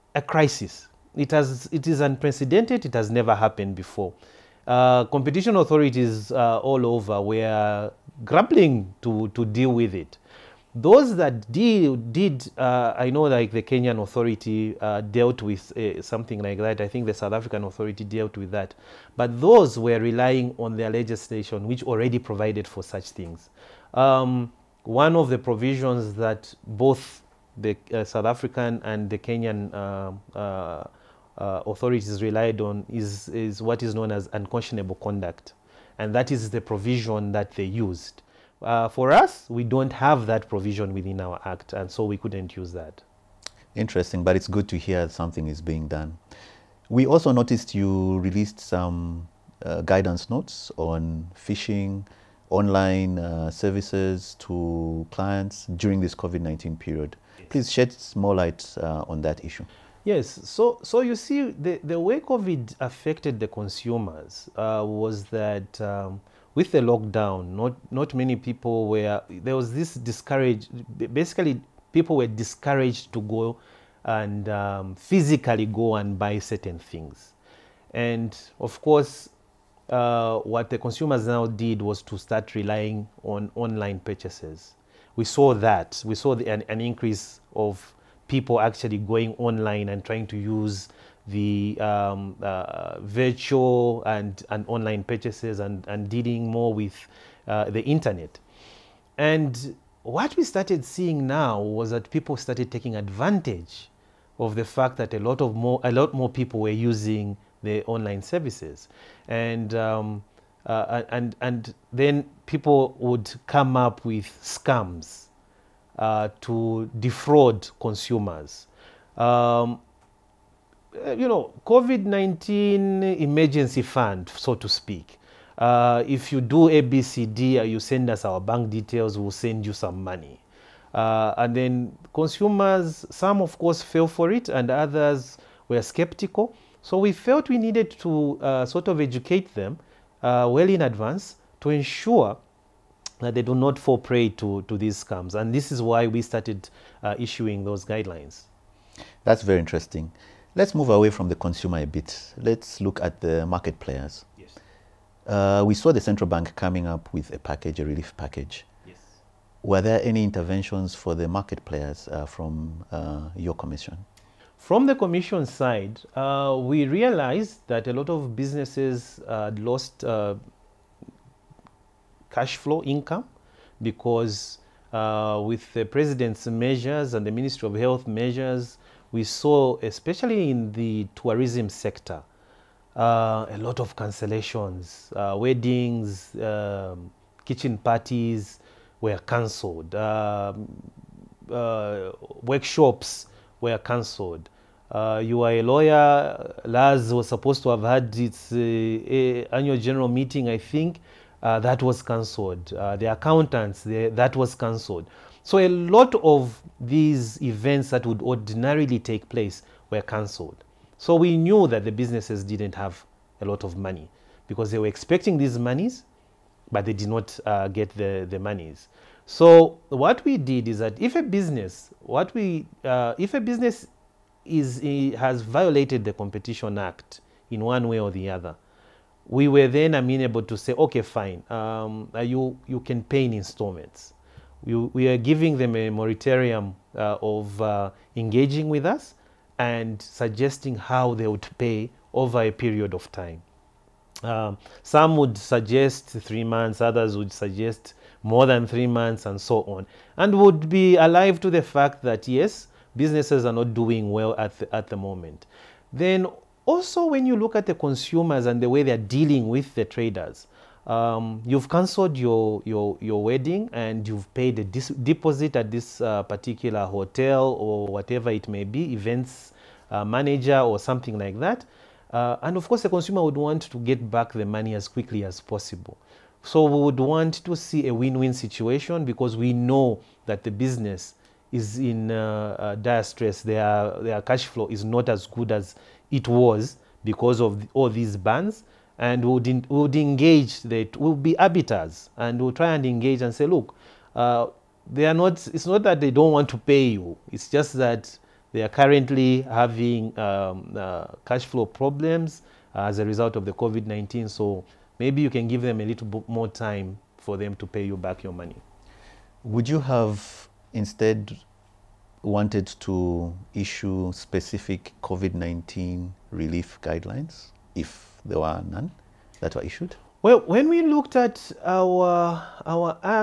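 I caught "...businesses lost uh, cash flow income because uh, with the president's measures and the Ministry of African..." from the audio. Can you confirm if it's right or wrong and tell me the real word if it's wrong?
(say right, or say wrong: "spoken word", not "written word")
wrong: "Health", not "African".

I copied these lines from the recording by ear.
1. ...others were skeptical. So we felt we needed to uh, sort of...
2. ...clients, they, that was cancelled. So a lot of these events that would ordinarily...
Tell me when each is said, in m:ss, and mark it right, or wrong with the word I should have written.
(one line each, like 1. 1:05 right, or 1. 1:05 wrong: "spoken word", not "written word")
1. 2:14 right
2. 3:23 wrong: "accountants", not "clients".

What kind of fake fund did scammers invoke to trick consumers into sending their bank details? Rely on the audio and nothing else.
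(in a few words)
COVID-19 emergency fund.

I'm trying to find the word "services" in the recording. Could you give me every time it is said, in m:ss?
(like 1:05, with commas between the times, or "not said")
0:53, 1:48.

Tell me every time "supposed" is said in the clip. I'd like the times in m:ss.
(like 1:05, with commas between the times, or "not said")
3:17.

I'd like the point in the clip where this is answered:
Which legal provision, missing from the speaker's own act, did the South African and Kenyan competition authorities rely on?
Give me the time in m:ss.
0:34.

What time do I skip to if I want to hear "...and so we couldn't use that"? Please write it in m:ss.
0:41.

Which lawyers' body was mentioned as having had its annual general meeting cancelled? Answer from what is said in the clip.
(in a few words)
LAZ.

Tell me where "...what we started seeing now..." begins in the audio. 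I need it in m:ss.
1:40.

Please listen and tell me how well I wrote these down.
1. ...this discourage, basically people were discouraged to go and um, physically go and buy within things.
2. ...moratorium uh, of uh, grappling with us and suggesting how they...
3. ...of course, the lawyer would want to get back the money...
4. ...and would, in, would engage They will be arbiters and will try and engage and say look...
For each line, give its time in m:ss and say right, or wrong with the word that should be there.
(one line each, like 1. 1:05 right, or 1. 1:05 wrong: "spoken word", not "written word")
1. 1:09 wrong: "certain", not "within"
2. 3:55 wrong: "engaging", not "grappling"
3. 4:32 wrong: "consumer", not "lawyer"
4. 4:48 right.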